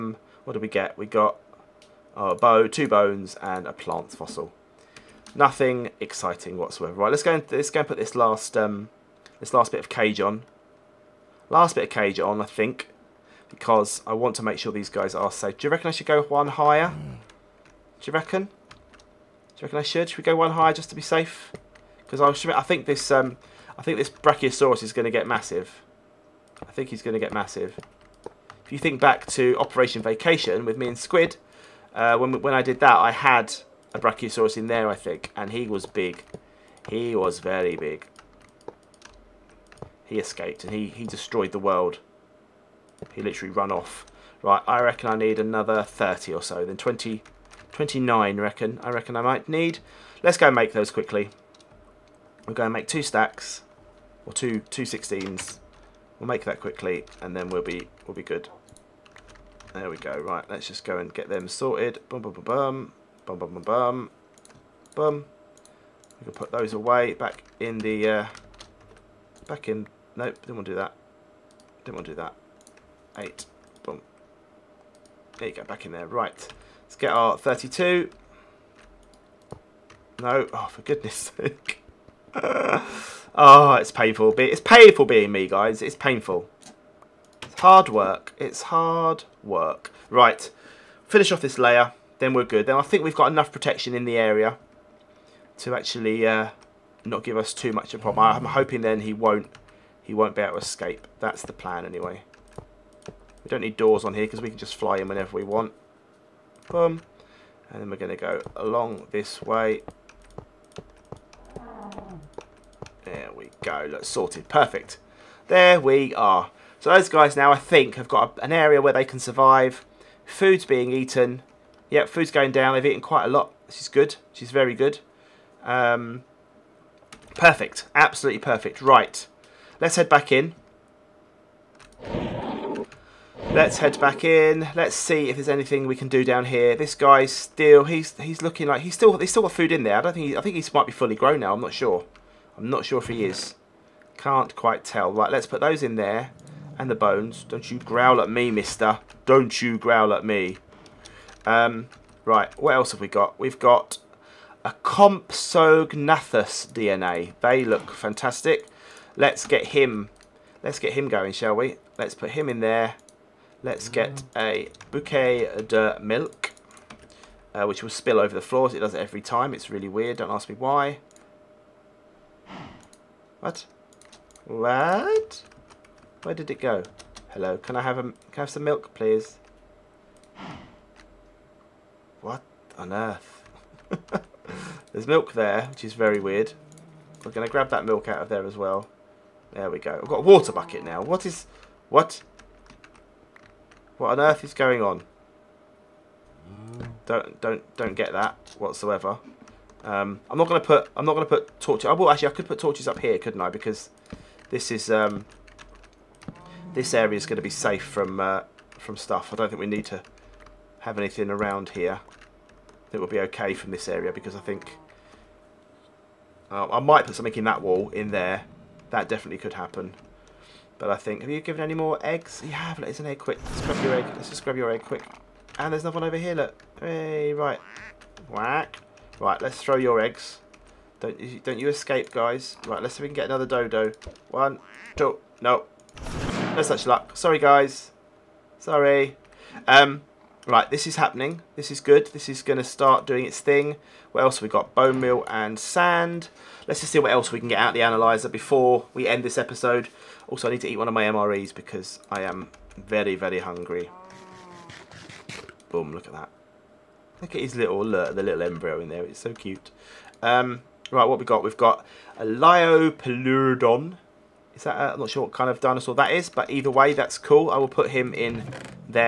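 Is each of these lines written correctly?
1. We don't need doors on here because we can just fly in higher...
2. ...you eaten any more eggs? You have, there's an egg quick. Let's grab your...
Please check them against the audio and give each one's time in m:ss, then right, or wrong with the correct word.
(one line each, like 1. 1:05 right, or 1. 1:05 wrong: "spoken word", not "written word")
1. 1:43 wrong: "whenever", not "higher"
2. 3:41 wrong: "given", not "eaten".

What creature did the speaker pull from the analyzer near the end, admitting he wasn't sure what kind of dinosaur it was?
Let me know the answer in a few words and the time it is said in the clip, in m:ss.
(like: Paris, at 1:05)
Liopleurodon, at 4:22.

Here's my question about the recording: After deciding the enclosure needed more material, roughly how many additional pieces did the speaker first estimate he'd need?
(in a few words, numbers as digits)
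30.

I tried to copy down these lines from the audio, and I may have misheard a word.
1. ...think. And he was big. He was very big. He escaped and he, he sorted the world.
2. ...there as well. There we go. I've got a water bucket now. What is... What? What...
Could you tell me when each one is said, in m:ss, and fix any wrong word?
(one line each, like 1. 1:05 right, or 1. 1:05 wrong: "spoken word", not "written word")
1. 0:34 wrong: "destroyed", not "sorted"
2. 3:08 right.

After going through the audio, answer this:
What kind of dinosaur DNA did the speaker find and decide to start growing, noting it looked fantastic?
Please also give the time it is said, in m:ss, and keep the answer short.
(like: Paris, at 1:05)
Compsognathus, at 2:34.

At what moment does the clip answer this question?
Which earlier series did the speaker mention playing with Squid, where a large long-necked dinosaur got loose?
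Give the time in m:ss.
0:29.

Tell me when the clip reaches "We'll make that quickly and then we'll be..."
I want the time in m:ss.
0:56.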